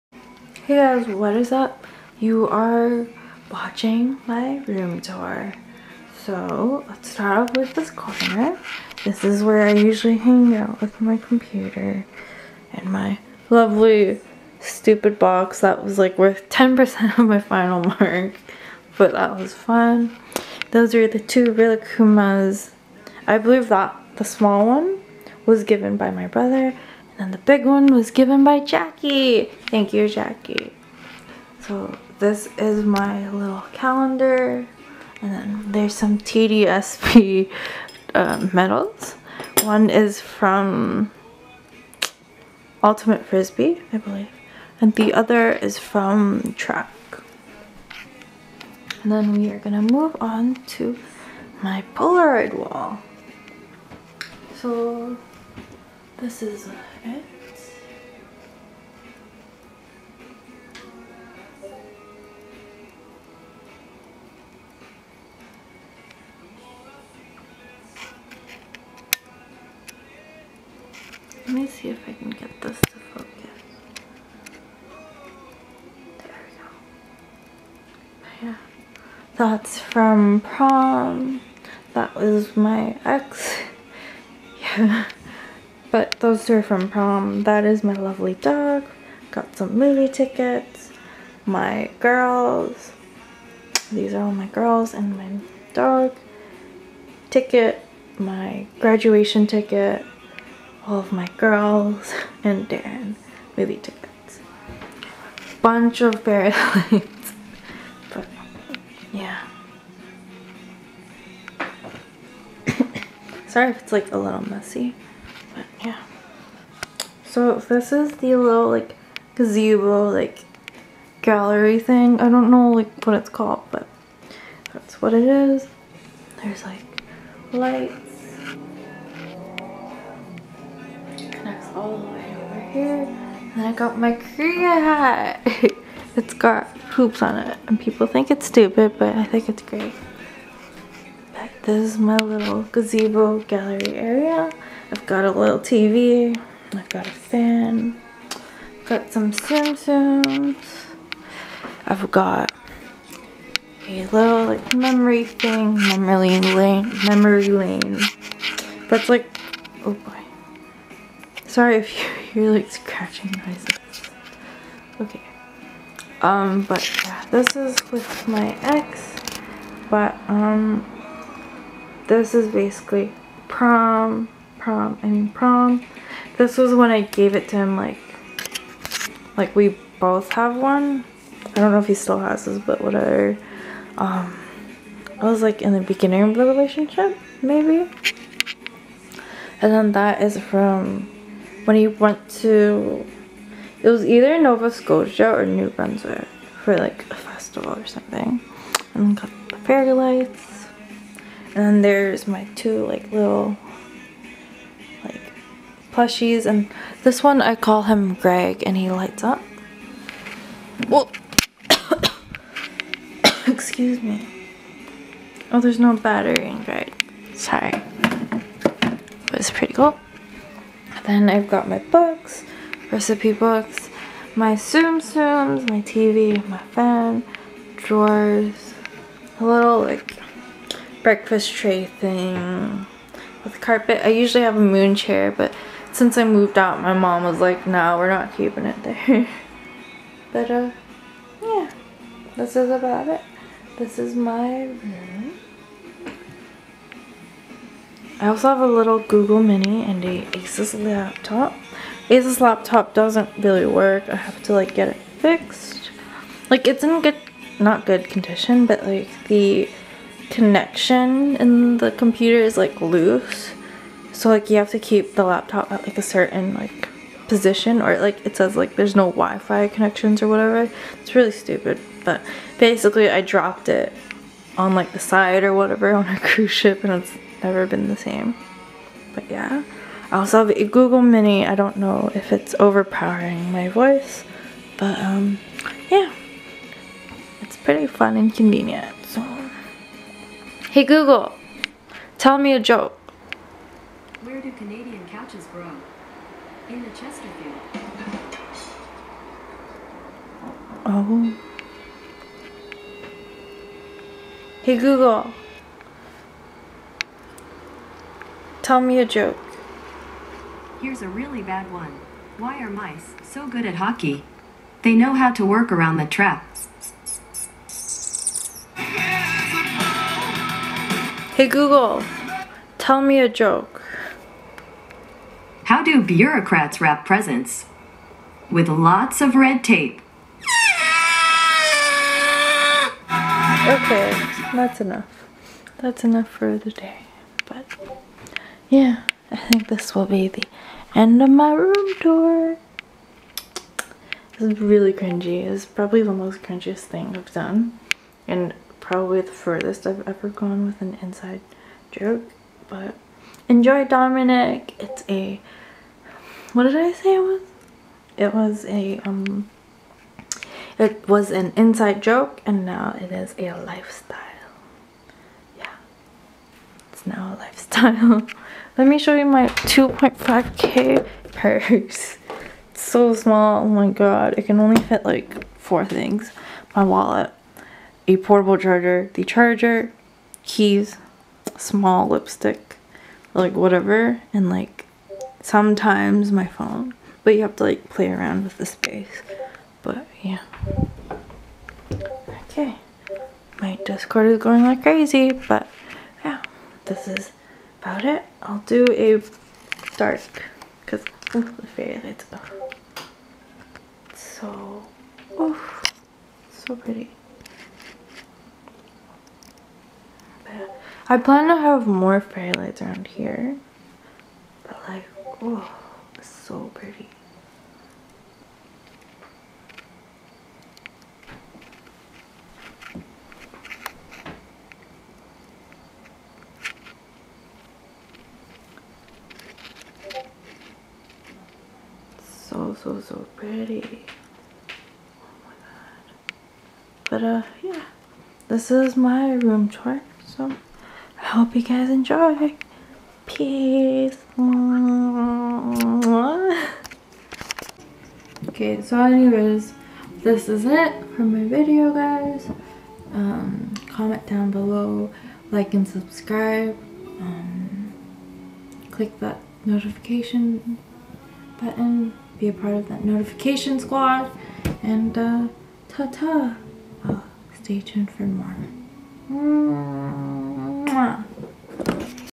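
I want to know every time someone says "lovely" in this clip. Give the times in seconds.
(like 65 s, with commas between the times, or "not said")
13 s, 87 s.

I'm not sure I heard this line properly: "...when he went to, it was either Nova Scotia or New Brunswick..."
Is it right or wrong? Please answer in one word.
right.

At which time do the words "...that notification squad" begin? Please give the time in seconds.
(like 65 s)
462 s.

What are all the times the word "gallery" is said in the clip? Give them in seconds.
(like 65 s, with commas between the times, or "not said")
121 s, 143 s.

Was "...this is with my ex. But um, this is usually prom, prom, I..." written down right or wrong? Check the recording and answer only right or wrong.
wrong.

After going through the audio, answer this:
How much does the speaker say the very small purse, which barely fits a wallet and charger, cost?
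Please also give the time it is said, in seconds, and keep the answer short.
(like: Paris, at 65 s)
2.5k, at 369 s.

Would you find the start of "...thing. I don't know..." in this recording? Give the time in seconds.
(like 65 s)
121 s.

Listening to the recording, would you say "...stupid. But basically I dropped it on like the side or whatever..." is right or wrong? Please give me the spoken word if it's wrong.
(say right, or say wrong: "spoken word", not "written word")
right.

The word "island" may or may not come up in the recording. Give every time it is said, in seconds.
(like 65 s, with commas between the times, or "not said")
not said.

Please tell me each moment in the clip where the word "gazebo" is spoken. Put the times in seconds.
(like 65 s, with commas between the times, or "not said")
119 s, 142 s.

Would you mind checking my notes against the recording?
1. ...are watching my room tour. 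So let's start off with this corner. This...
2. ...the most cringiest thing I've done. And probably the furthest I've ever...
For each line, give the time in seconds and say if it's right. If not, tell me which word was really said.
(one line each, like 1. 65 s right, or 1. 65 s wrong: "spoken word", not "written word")
1. 2 s right
2. 346 s right.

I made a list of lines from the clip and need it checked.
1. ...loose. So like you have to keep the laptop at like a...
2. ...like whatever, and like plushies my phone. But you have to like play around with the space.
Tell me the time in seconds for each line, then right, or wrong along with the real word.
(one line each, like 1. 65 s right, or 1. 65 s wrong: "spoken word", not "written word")
1. 262 s right
2. 383 s wrong: "sometimes", not "plushies".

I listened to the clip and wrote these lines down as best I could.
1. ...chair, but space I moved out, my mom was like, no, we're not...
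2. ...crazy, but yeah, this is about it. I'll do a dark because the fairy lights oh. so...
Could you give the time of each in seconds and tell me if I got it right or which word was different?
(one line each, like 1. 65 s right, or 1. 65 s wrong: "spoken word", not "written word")
1. 234 s wrong: "since", not "space"
2. 394 s right.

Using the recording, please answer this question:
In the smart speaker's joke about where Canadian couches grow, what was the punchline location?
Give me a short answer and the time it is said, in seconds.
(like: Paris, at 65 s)
the Chesterfield, at 296 s.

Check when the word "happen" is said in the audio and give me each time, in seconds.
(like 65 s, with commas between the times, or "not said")
not said.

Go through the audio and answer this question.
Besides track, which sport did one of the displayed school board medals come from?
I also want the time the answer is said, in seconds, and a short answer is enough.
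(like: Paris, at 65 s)
Ultimate Frisbee, at 42 s.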